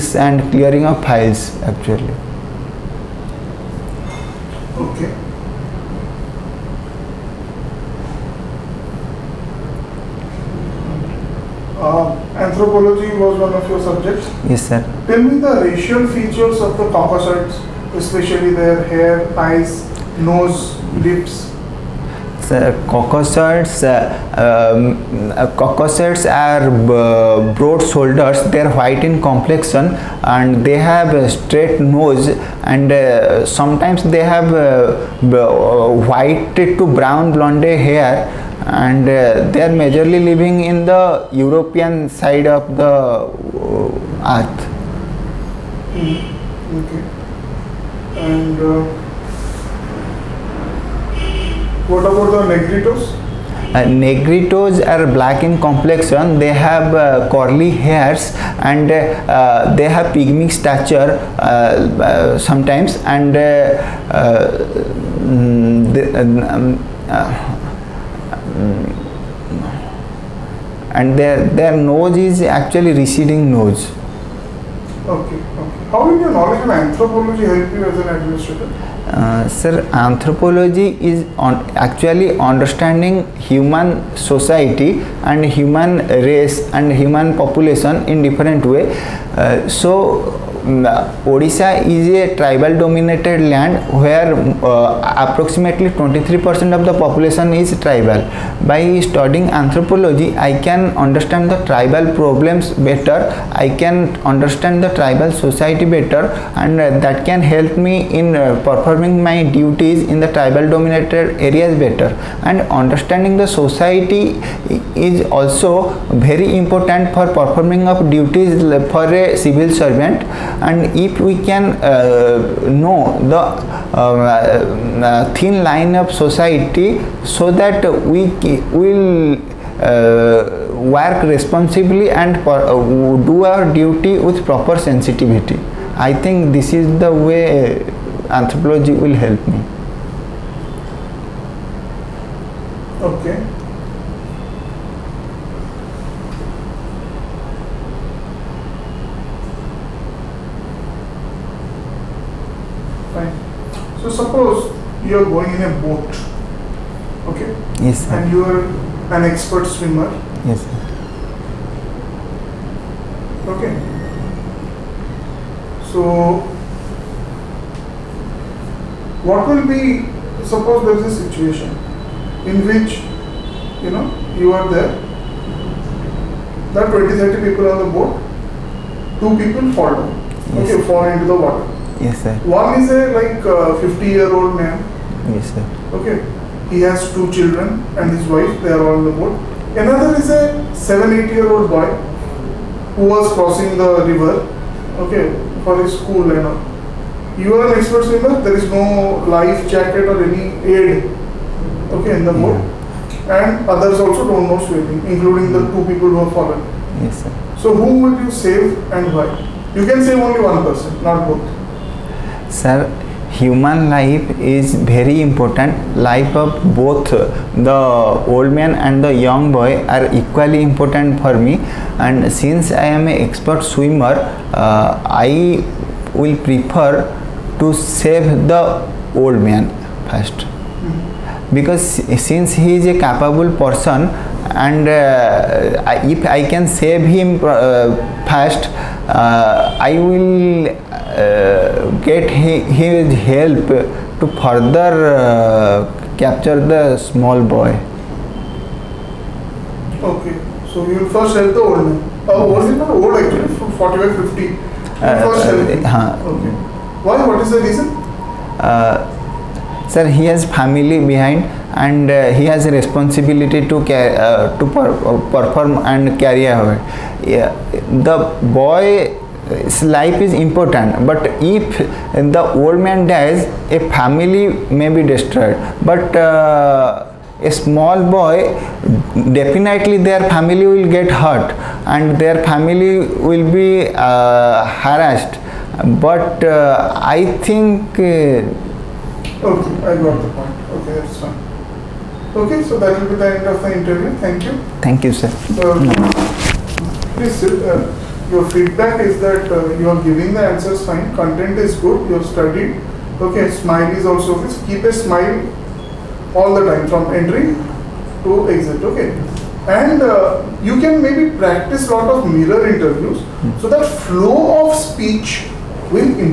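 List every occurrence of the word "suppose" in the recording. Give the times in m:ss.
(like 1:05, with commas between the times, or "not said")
2:34, 2:50.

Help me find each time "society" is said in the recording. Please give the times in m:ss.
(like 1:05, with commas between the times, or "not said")
1:24, 1:45, 1:53, 2:06.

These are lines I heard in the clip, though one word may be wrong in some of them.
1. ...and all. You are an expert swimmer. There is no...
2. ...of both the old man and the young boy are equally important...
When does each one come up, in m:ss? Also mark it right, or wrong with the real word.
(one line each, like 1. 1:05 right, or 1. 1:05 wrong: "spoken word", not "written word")
1. 3:16 right
2. 3:36 right.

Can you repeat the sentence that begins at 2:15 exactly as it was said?
I think this is the way anthropology will help me.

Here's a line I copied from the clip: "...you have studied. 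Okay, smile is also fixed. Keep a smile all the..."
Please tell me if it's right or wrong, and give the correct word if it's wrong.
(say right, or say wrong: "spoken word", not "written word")
right.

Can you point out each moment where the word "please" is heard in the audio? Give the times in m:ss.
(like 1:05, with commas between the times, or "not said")
4:57.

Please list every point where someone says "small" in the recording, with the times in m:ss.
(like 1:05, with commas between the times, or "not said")
4:06, 4:37.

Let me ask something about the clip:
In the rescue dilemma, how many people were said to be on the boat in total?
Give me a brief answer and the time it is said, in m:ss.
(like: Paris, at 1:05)
20, 30, at 2:57.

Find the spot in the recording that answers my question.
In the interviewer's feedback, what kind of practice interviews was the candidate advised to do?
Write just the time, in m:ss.
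5:12.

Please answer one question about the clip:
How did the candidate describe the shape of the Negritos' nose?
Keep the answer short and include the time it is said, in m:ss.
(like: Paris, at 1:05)
receding, at 1:12.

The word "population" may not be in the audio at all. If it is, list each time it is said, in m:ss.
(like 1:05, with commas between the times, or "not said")
1:27, 1:36.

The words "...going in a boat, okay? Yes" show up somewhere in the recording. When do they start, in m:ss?
2:35.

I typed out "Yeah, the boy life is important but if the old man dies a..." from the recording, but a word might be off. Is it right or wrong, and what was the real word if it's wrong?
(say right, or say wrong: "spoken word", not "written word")
right.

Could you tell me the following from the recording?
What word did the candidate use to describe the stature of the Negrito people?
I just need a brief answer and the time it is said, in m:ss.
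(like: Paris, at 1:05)
pygmy, at 1:00.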